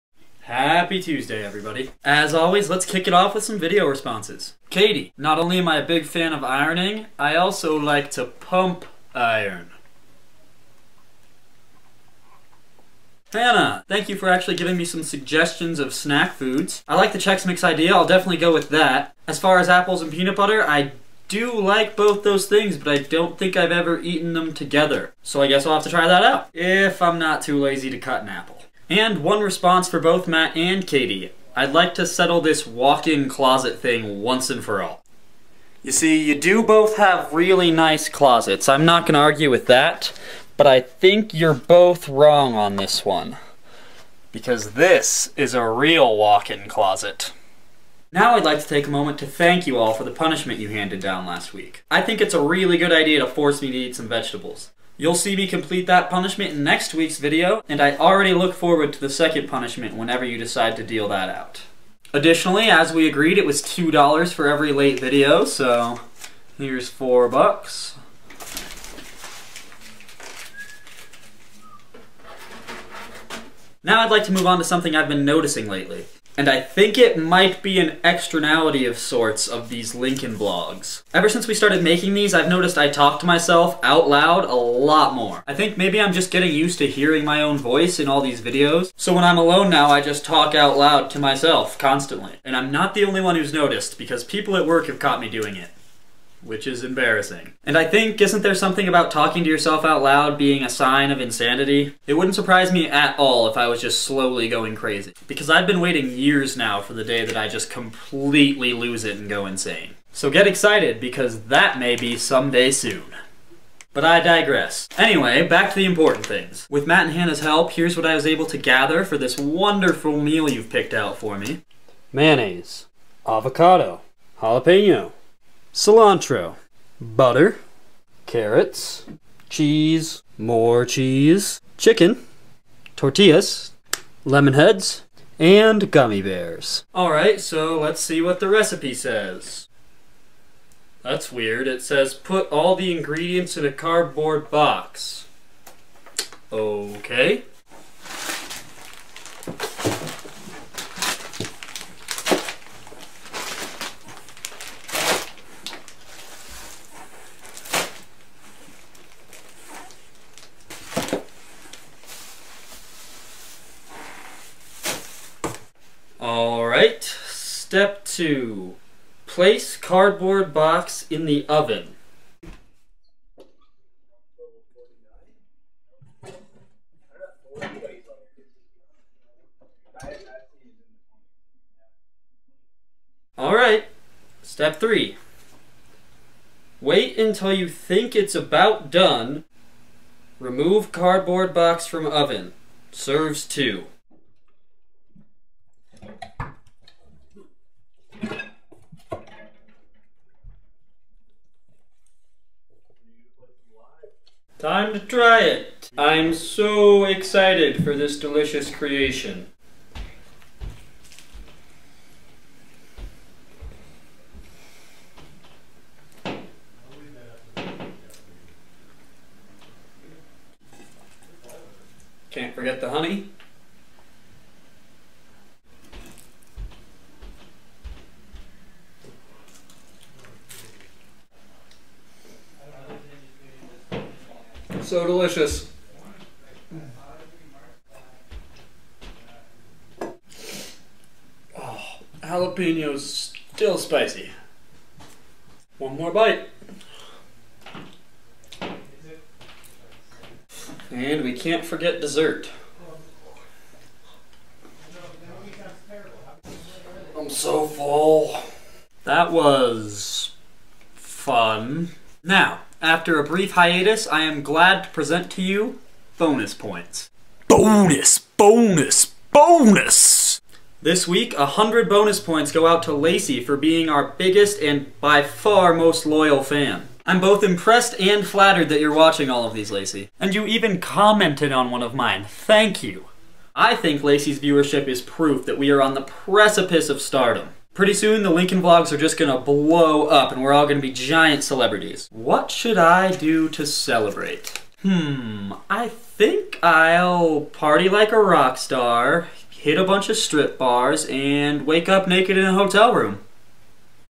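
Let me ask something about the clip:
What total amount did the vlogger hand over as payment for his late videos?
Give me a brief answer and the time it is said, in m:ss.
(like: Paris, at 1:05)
4 bucks, at 1:06.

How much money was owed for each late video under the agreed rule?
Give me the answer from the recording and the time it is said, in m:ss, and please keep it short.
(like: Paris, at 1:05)
$2, at 1:03.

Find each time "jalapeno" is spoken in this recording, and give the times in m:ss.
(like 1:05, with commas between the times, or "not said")
2:04, 4:02.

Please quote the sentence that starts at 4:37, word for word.
I'm both impressed and flattered that you're watching all of these, Lacey.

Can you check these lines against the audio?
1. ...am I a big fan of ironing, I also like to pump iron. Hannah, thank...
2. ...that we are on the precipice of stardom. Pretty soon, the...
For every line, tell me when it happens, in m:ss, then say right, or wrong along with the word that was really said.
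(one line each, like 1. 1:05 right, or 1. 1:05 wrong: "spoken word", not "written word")
1. 0:05 right
2. 4:45 right.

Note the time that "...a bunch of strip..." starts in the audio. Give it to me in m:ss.
4:59.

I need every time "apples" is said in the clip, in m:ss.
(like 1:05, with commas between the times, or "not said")
0:19, 0:28.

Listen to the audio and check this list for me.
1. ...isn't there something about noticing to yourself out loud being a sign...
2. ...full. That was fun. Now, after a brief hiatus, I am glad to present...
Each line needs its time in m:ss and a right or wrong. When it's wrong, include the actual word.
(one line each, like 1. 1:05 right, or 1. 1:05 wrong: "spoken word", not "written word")
1. 1:38 wrong: "talking", not "noticing"
2. 4:17 right.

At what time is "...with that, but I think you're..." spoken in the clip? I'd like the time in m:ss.
0:39.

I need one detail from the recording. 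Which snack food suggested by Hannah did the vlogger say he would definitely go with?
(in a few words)
Chex Mix.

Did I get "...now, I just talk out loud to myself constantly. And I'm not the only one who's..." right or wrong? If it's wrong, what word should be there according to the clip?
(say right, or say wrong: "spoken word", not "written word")
right.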